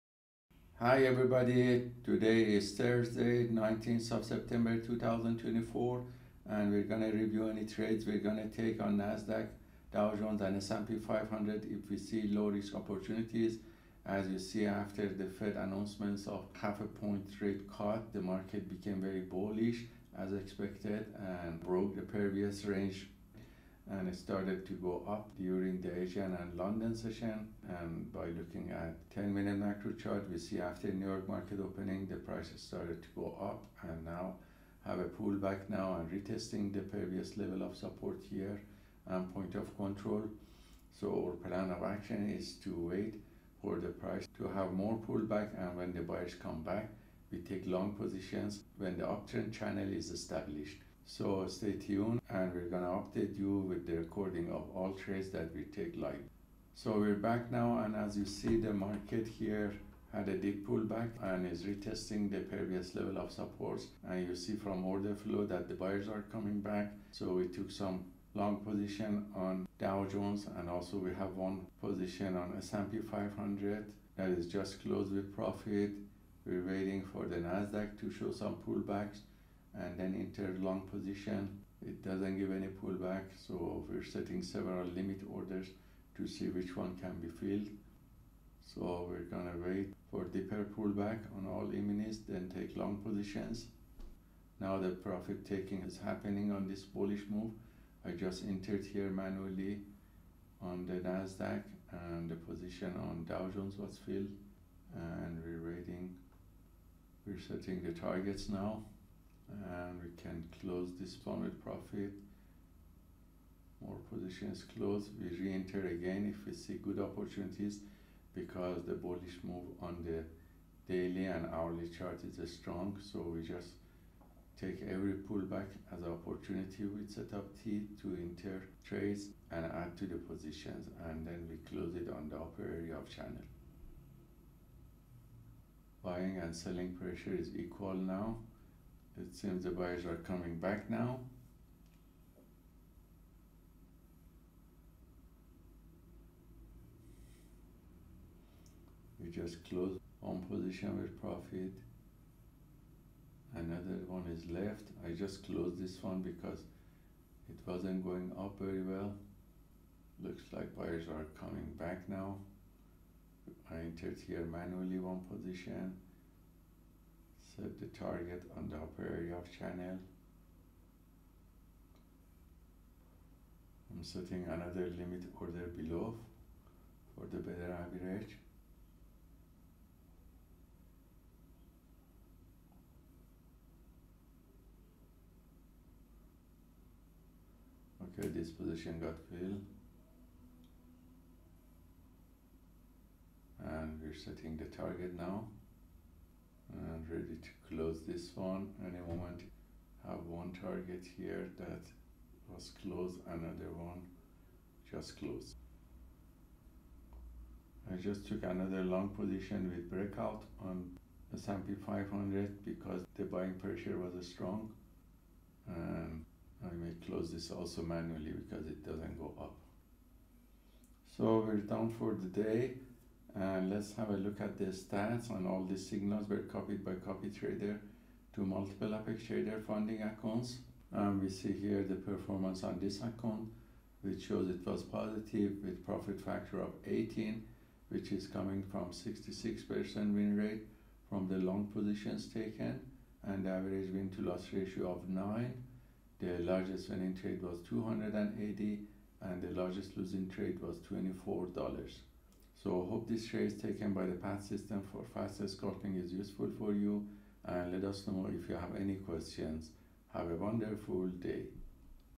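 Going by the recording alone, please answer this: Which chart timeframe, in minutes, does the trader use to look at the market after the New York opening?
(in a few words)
10 minute.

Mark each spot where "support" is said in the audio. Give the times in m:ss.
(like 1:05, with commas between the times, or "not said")
0:37, 1:03.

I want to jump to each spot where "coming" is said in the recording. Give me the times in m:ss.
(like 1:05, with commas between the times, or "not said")
1:06, 2:20, 2:41, 3:58.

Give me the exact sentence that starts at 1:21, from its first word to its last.
It doesn't give any pullback, so we're setting several limit orders to see which one can be filled.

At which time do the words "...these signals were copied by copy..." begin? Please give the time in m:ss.
3:45.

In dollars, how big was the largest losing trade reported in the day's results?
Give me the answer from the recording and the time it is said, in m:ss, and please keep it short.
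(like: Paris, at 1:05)
$24, at 4:10.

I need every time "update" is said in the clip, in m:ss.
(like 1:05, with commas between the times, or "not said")
0:53.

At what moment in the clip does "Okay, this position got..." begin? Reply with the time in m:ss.
3:08.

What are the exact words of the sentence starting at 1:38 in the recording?
I just entered here manually on the Nasdaq and the position on Dow Jones was filled and we're waiting.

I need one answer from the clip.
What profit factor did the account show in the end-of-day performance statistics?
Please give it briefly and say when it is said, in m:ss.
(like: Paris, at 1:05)
18, at 3:56.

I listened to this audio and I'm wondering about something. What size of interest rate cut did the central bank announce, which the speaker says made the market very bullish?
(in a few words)
half a point.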